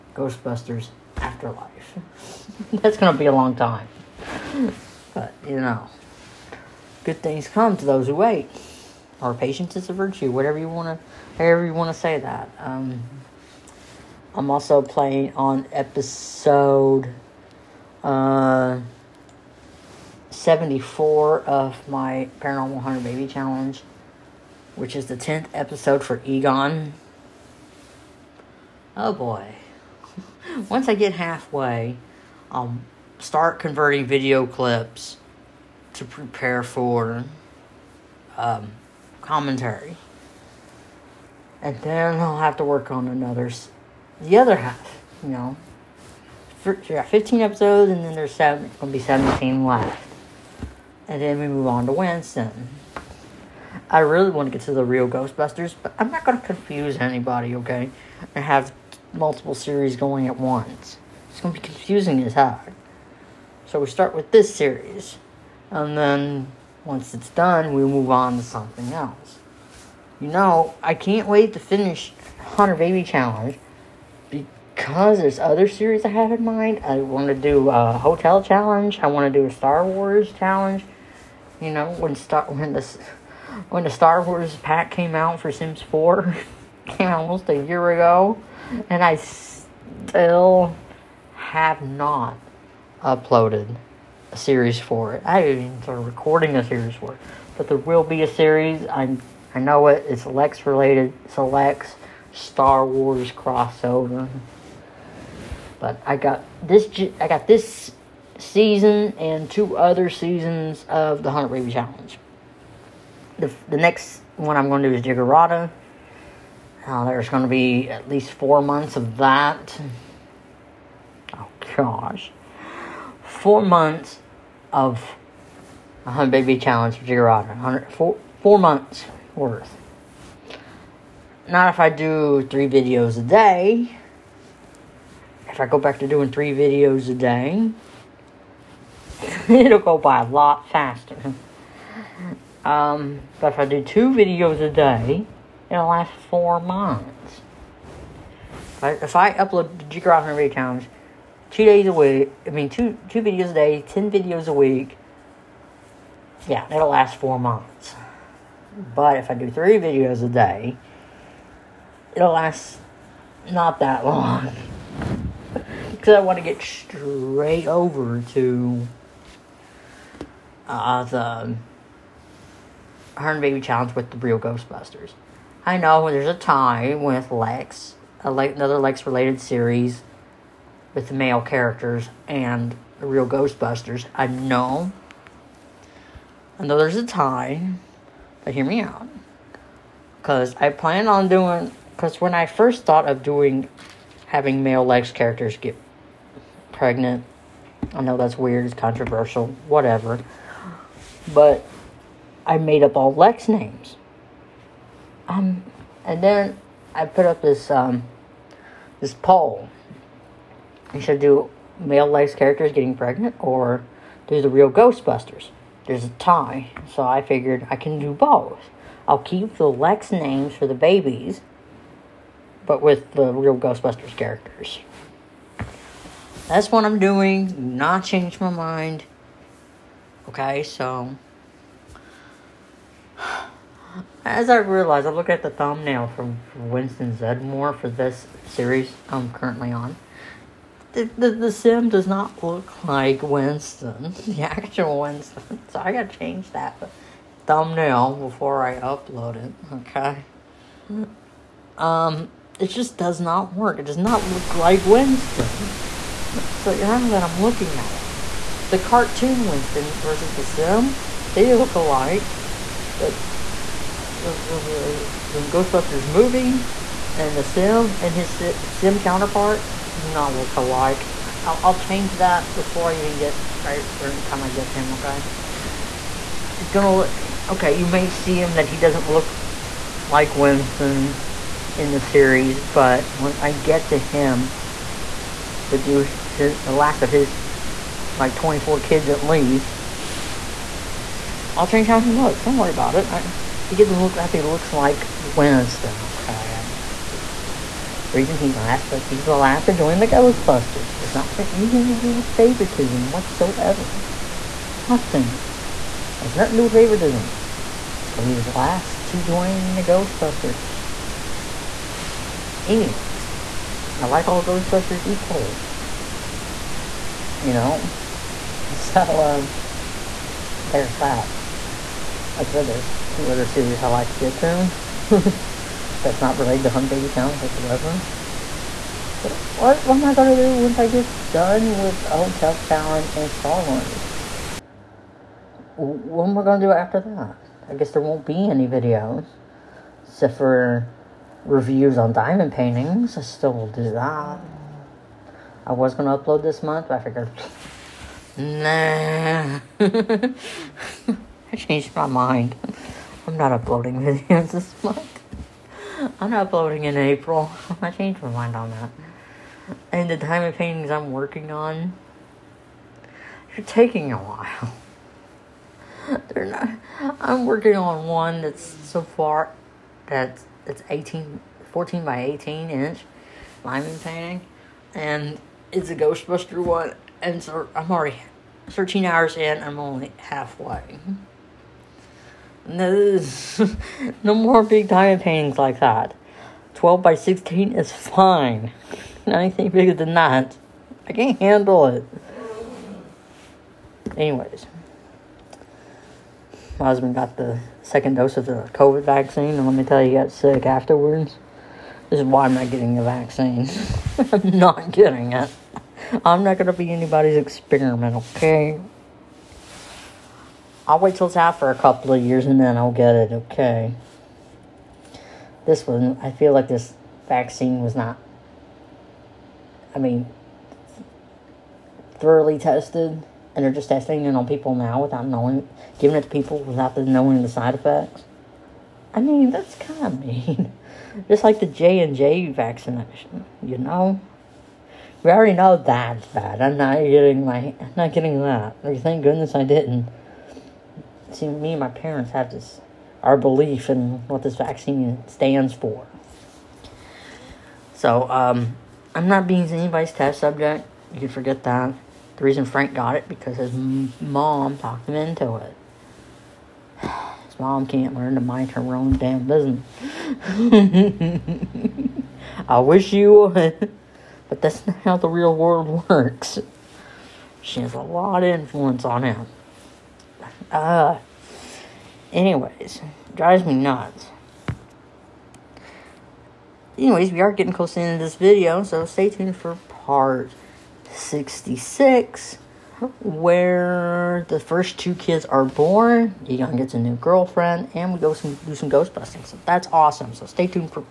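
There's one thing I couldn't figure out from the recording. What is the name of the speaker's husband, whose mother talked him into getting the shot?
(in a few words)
Frank.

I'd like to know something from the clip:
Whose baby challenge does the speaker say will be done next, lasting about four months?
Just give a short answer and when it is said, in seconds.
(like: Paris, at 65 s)
Jiggerata, at 115 s.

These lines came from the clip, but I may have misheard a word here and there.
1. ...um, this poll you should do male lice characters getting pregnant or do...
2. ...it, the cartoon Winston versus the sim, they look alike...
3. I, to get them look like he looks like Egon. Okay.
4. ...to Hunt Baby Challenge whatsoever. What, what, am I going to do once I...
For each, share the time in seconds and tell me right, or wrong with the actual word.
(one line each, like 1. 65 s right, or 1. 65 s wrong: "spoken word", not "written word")
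1. 207 s right
2. 257 s right
3. 293 s wrong: "Winston", not "Egon"
4. 326 s right.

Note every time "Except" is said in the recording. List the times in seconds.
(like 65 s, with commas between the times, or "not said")
340 s.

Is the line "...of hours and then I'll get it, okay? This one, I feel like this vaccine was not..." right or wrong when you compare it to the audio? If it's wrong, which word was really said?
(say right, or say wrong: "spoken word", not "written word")
wrong: "years", not "hours".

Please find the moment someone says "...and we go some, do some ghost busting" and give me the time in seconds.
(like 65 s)
487 s.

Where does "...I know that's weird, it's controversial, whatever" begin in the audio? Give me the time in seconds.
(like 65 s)
197 s.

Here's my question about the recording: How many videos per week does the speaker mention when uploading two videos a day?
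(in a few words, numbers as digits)
10.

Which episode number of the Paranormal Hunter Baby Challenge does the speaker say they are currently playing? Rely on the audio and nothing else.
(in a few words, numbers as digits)
74.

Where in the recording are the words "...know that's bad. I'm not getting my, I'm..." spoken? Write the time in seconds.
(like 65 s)
435 s.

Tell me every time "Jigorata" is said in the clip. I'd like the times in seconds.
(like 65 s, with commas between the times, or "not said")
127 s, 149 s.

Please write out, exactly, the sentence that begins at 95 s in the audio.
I haven't even started recording a series for it.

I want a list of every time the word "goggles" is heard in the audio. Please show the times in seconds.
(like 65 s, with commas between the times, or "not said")
not said.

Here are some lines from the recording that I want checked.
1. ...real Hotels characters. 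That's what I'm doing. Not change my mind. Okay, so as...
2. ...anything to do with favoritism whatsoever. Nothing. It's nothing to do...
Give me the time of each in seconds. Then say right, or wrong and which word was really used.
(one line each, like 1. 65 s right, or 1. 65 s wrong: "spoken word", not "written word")
1. 223 s wrong: "Ghostbusters", not "Hotels"
2. 301 s right.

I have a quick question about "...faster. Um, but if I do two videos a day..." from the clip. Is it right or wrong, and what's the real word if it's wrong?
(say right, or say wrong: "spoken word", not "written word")
right.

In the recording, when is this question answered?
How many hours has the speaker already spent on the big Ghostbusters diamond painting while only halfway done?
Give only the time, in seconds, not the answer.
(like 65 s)
378 s.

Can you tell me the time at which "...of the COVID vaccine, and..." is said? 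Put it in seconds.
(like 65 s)
398 s.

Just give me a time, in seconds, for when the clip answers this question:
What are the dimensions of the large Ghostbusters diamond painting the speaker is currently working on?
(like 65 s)
371 s.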